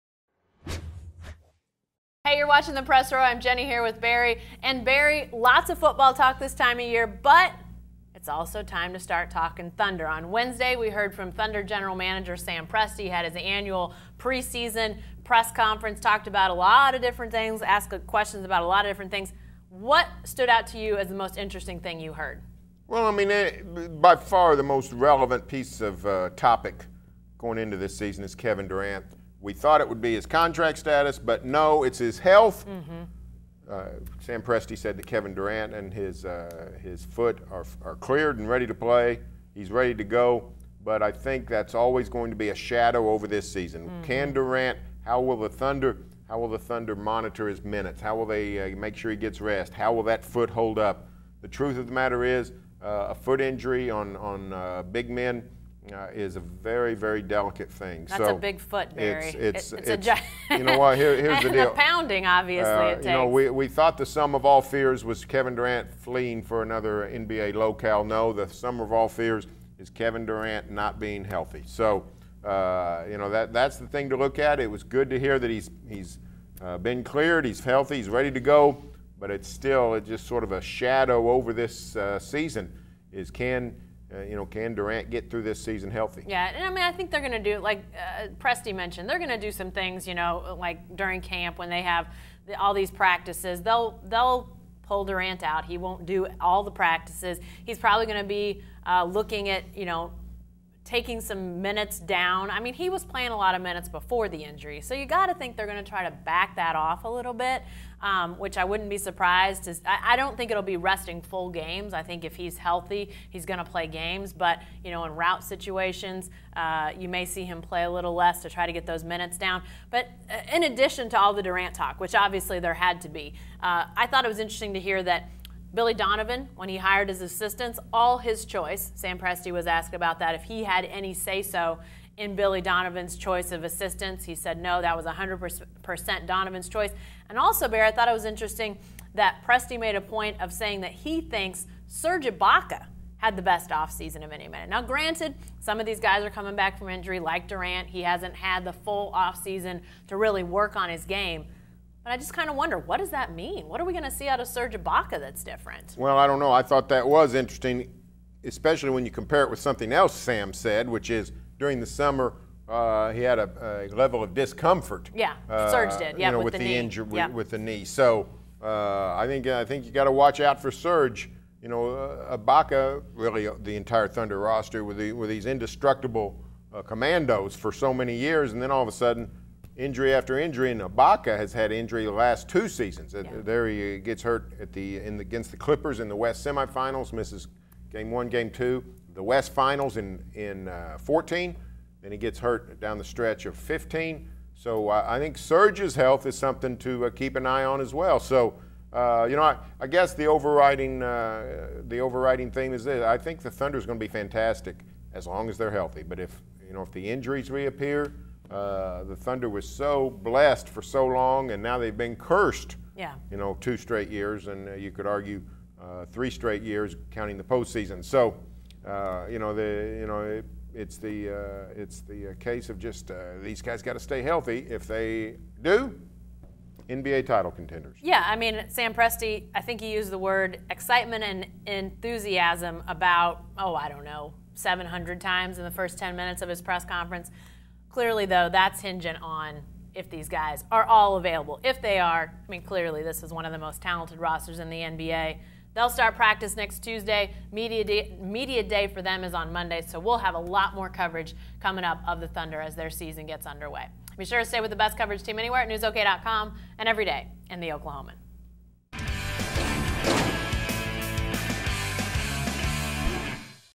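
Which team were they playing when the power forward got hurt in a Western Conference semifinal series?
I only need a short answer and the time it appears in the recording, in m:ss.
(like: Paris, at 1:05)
Clippers, at 3:05.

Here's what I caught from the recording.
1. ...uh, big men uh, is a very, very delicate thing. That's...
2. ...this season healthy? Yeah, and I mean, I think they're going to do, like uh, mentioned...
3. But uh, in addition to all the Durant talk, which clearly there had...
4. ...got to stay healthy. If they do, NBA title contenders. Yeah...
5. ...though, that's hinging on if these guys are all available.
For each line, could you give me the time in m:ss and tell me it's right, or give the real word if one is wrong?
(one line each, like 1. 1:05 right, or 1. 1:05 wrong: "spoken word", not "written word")
1. 0:54 right
2. 1:25 right
3. 1:59 wrong: "obviously", not "clearly"
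4. 3:43 right
5. 3:58 right.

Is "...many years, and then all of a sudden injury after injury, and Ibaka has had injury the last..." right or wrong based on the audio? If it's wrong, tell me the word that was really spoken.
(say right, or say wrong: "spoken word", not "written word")
right.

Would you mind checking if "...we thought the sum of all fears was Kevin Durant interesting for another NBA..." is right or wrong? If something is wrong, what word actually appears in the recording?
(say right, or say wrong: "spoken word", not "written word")
wrong: "fleeing", not "interesting".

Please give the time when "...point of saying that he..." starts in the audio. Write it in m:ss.
2:20.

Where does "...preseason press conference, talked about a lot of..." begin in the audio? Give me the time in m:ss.
0:14.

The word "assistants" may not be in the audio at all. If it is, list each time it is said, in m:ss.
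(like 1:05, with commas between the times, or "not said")
2:07, 2:13.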